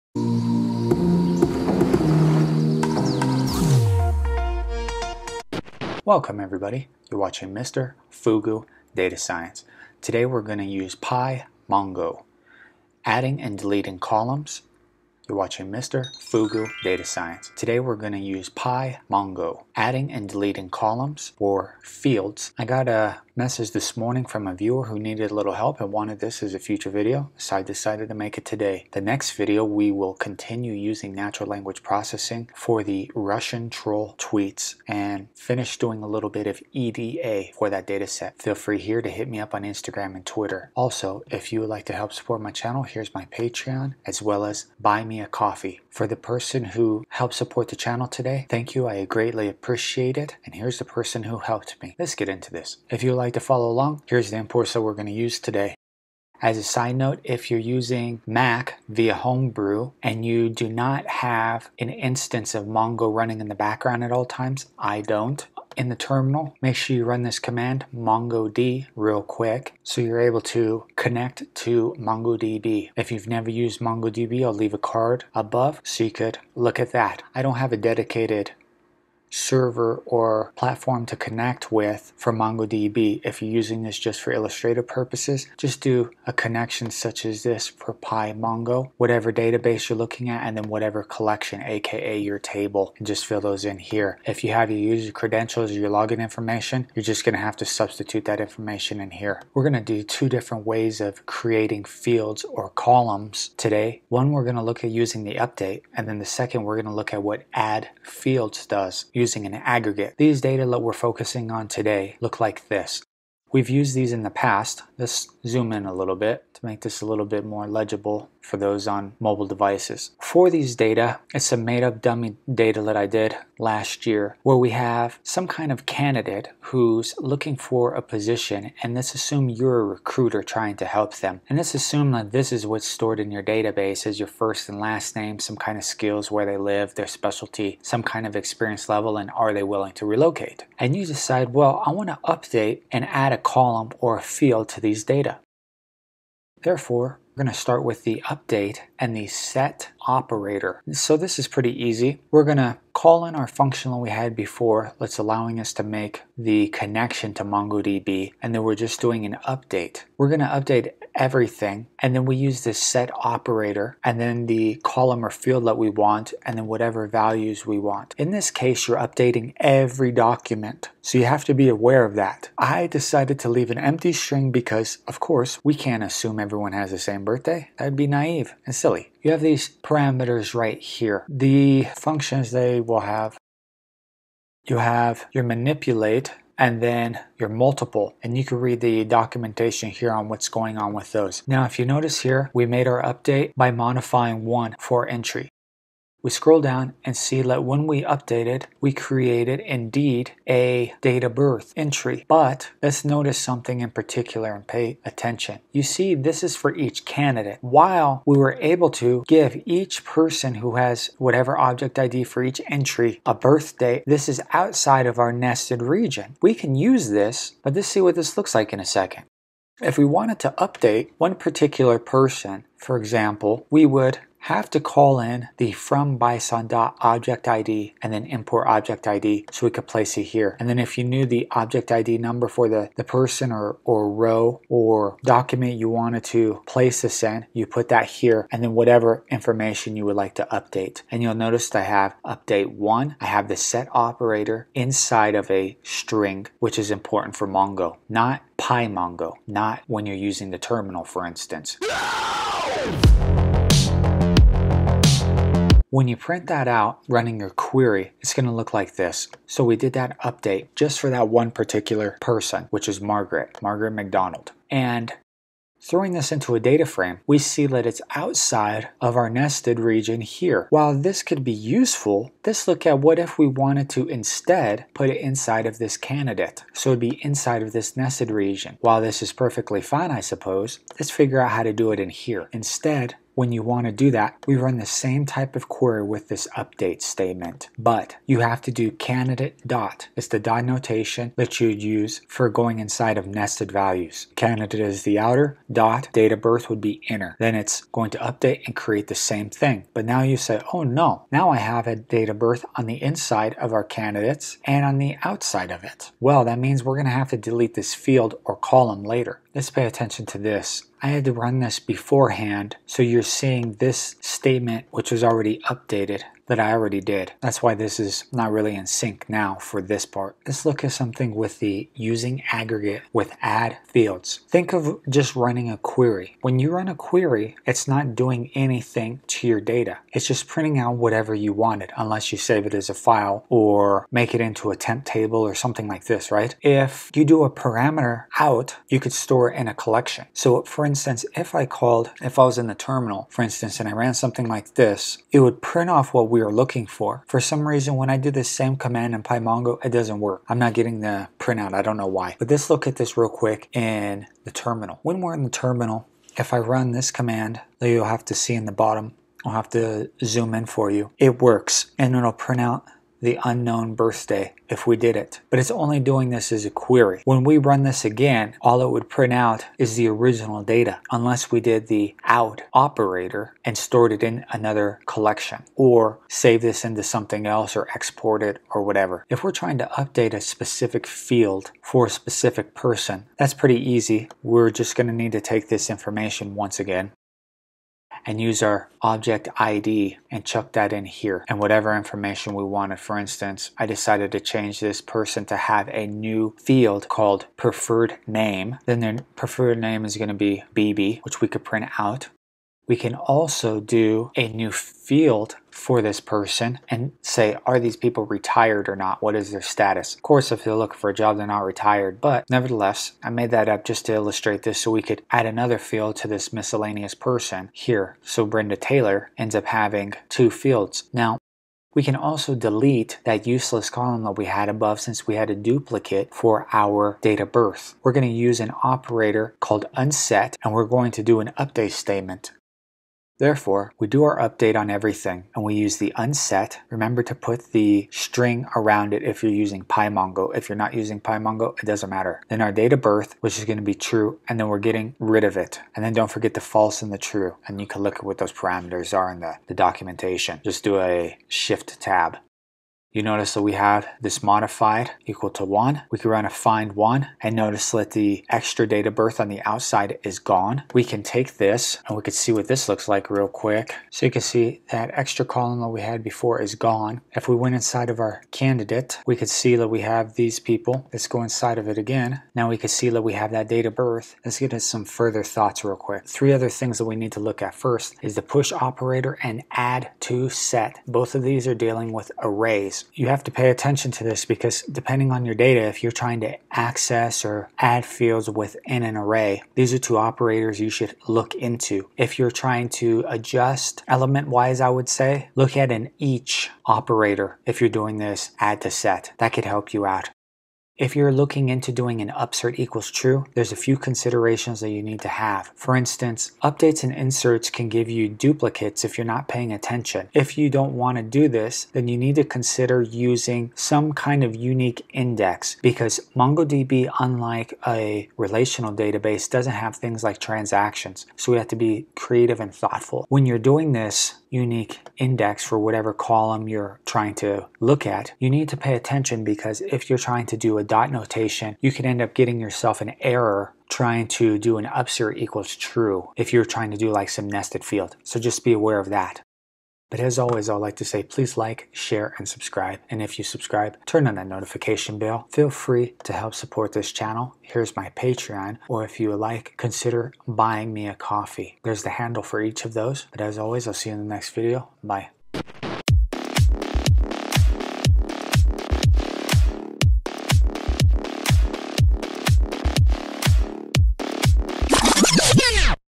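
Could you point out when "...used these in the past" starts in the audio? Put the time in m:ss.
1:53.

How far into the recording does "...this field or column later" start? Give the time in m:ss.
5:07.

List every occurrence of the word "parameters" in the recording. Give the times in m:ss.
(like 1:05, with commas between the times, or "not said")
2:59, 5:37, 7:28.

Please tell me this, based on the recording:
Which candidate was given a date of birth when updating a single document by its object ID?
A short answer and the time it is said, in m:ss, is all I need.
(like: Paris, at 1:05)
Margaret McDonald, at 4:23.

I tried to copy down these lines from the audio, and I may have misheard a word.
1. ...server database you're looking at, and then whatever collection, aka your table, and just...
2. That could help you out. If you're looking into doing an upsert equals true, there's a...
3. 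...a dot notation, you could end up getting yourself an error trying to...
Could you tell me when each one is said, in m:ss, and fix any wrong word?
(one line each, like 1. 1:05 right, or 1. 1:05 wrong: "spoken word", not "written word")
1. 1:28 wrong: "whatever", not "server"
2. 8:19 right
3. 8:50 right.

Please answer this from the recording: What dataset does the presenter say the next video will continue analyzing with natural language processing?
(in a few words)
Russian troll tweets.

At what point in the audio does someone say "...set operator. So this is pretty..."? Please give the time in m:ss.
2:29.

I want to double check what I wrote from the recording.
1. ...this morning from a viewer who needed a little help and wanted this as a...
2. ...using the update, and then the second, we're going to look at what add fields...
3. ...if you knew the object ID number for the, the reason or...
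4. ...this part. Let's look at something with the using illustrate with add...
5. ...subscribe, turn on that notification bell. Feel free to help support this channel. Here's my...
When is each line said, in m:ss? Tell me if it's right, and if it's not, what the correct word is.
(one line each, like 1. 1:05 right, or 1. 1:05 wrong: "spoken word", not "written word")
1. 0:23 right
2. 1:44 right
3. 3:50 wrong: "person", not "reason"
4. 5:19 wrong: "aggregate", not "illustrate"
5. 9:03 right.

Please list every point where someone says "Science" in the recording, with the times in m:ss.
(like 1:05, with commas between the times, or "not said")
0:09, 0:17.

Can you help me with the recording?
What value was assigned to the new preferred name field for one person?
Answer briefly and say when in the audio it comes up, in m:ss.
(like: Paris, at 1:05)
BB, at 6:40.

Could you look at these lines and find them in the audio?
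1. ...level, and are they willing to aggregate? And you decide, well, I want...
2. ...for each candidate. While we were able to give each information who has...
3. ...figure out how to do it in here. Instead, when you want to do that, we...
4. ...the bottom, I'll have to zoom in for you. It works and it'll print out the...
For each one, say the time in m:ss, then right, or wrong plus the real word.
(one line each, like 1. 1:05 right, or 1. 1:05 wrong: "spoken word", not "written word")
1. 2:18 wrong: "relocate", not "aggregate"
2. 3:26 wrong: "person", not "information"
3. 4:41 right
4. 5:58 right.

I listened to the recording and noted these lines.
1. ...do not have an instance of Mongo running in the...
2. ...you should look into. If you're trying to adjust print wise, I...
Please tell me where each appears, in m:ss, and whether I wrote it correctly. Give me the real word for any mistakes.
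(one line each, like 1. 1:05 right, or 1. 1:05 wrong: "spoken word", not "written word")
1. 1:00 right
2. 8:10 wrong: "element", not "print".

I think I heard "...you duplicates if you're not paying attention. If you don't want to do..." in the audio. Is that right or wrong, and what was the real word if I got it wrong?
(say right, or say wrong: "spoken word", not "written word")
right.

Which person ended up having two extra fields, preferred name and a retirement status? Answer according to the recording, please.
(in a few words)
Brenda Taylor.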